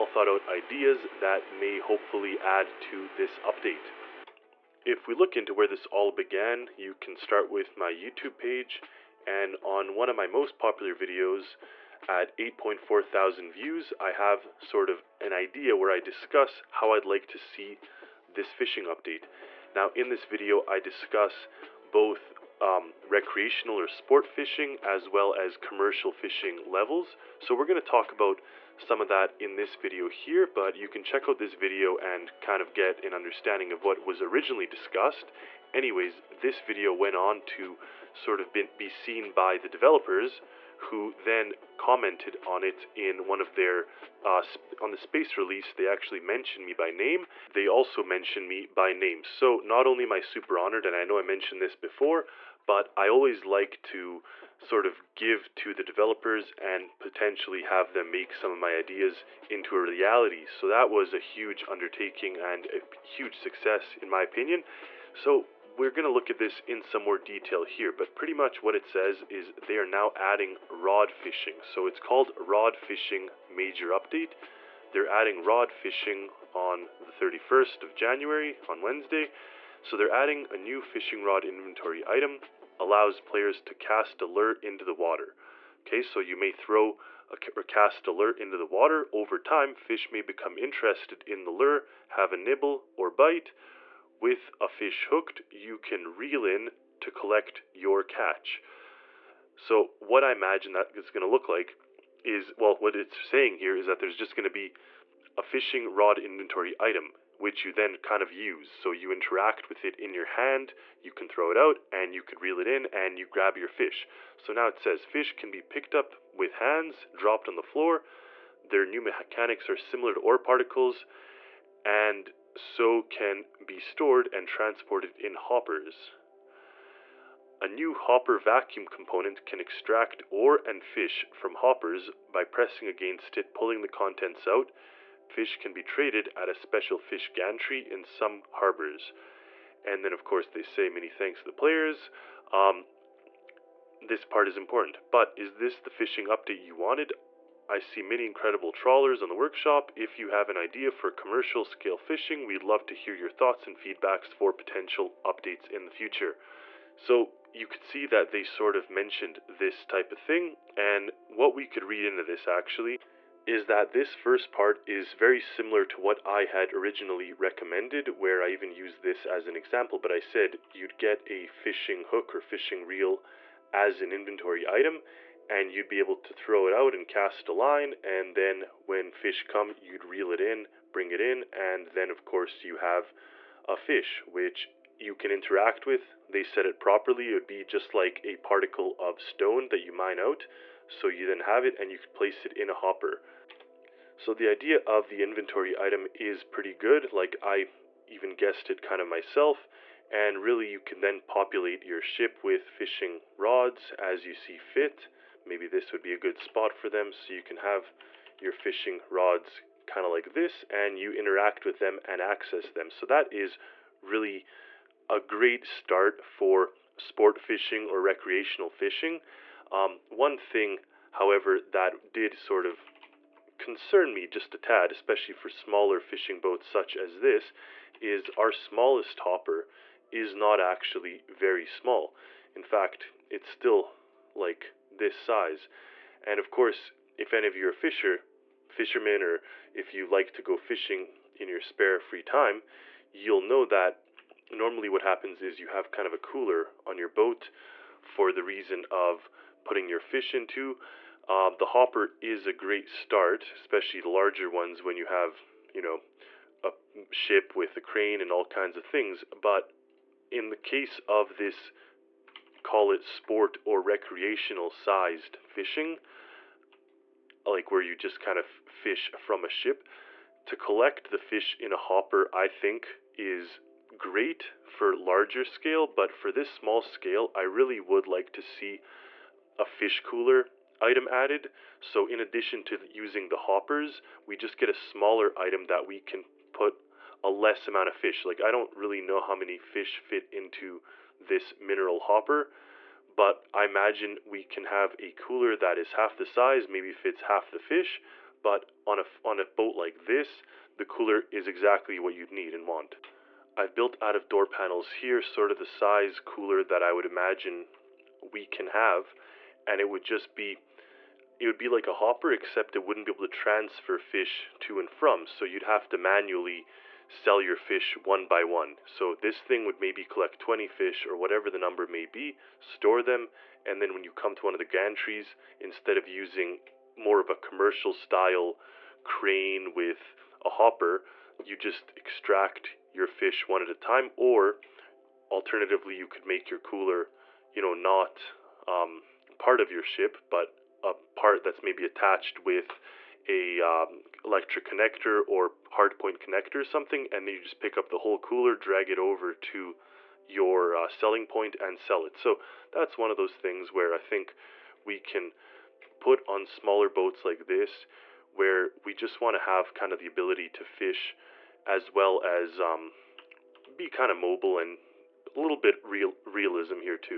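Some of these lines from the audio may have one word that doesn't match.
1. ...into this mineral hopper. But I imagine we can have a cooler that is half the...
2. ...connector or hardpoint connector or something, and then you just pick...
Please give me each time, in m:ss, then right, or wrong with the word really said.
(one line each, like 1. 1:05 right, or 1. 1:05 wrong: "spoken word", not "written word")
1. 4:50 right
2. 5:44 right.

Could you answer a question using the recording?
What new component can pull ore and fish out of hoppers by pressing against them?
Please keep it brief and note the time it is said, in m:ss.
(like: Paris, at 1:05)
hopper vacuum, at 2:07.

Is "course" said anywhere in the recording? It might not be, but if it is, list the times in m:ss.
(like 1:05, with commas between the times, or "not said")
2:20, 3:02, 3:56.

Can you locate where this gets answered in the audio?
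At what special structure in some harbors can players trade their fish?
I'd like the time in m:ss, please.
2:16.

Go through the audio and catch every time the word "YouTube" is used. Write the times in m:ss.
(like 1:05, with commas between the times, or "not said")
0:07.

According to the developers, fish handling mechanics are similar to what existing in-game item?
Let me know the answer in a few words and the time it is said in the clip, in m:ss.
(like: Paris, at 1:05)
ore particles, at 2:00.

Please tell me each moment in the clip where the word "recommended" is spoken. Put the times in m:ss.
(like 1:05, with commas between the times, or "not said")
2:47.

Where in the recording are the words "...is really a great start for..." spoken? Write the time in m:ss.
3:33.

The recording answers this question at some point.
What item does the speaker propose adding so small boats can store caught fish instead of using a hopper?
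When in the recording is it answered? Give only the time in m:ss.
4:39.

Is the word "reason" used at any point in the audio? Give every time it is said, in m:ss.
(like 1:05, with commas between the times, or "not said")
4:08.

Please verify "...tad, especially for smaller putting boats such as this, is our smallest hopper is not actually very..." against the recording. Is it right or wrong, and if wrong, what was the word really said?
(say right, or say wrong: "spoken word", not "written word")
wrong: "fishing", not "putting".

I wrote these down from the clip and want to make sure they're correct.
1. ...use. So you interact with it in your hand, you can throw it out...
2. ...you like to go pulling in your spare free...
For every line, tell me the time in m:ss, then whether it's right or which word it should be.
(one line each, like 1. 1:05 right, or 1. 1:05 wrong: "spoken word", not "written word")
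1. 1:48 right
2. 3:59 wrong: "fishing", not "pulling".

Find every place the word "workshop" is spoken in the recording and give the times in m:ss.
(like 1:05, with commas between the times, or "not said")
2:29.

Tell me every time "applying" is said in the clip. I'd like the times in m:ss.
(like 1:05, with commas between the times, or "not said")
not said.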